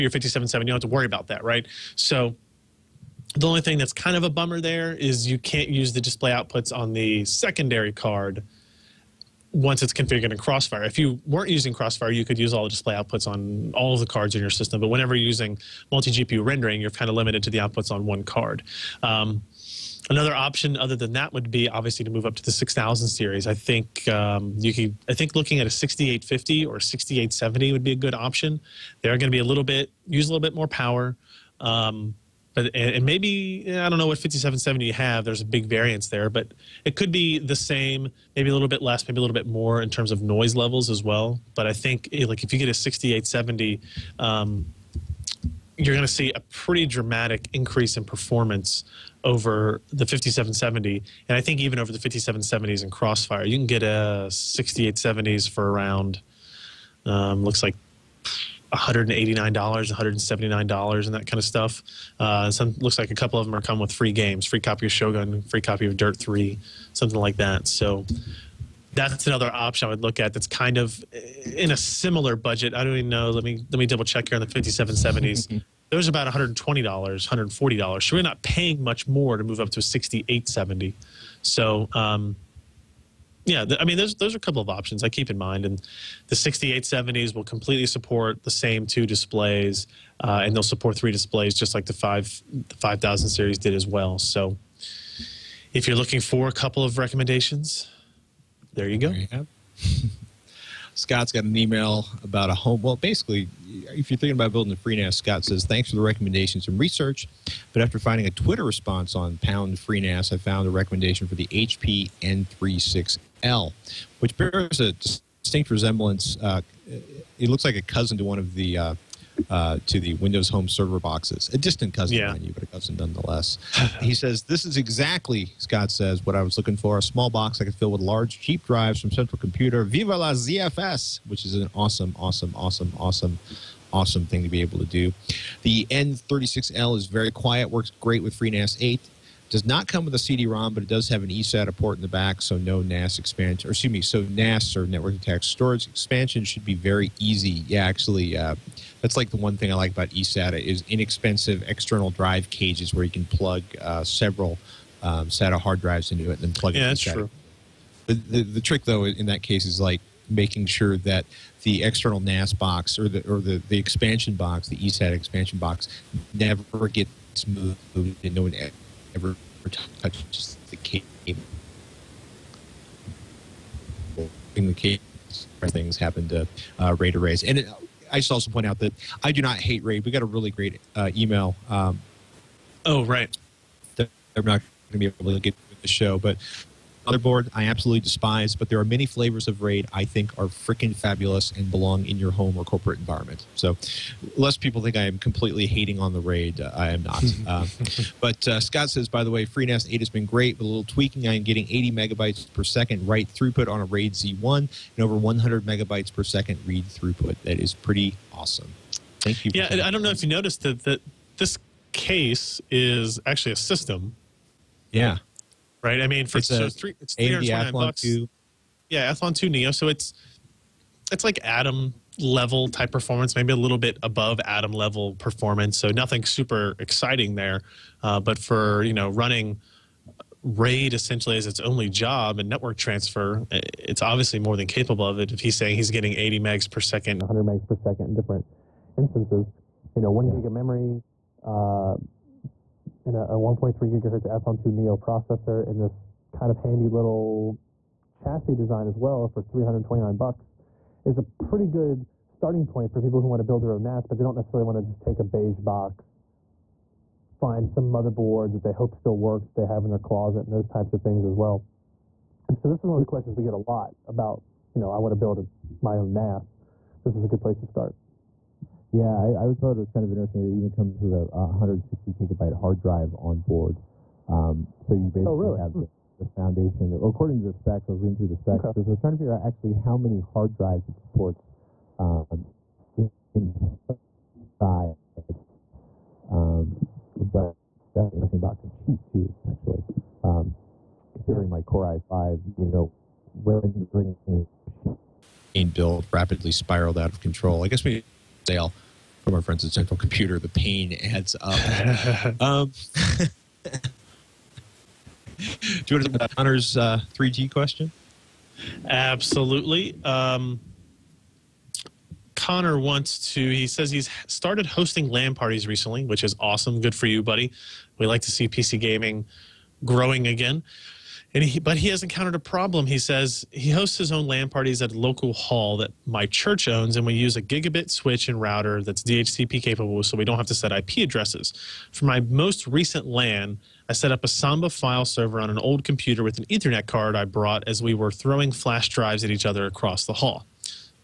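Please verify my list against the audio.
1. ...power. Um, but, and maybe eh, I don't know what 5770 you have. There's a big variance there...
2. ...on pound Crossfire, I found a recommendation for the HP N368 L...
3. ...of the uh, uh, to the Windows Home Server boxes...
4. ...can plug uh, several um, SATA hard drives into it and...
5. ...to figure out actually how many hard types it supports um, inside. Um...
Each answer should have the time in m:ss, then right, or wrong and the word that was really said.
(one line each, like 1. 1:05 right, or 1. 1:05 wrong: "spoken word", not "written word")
1. 0:30 right
2. 1:49 wrong: "FreeNAS", not "Crossfire"
3. 1:58 right
4. 2:33 right
5. 4:39 wrong: "drives", not "types".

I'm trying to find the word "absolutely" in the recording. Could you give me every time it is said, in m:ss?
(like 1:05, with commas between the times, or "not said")
3:07, 5:08.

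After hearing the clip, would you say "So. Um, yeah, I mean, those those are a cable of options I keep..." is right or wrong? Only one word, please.
wrong.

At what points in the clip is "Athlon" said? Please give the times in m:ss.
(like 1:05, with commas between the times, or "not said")
3:39, 4:04.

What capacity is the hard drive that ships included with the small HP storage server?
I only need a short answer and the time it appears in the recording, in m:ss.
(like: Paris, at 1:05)
160 gigabyte, at 4:31.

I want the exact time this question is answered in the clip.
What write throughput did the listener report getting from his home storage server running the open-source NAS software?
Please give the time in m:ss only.
3:21.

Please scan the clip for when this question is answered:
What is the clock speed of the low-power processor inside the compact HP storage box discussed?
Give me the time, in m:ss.
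4:03.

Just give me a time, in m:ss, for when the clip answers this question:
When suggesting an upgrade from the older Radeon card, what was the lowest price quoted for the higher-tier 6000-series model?
0:59.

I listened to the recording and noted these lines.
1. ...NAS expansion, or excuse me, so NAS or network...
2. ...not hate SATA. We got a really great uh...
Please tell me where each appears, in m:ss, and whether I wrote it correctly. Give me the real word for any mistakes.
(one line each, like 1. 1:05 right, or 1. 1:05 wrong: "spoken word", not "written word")
1. 2:22 right
2. 2:59 wrong: "RAID", not "SATA".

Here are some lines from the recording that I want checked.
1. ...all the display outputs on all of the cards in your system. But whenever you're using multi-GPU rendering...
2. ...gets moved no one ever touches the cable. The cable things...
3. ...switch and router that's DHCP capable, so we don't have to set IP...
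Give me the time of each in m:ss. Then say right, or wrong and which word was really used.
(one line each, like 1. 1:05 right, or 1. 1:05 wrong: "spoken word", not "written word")
1. 0:12 right
2. 2:46 right
3. 5:27 right.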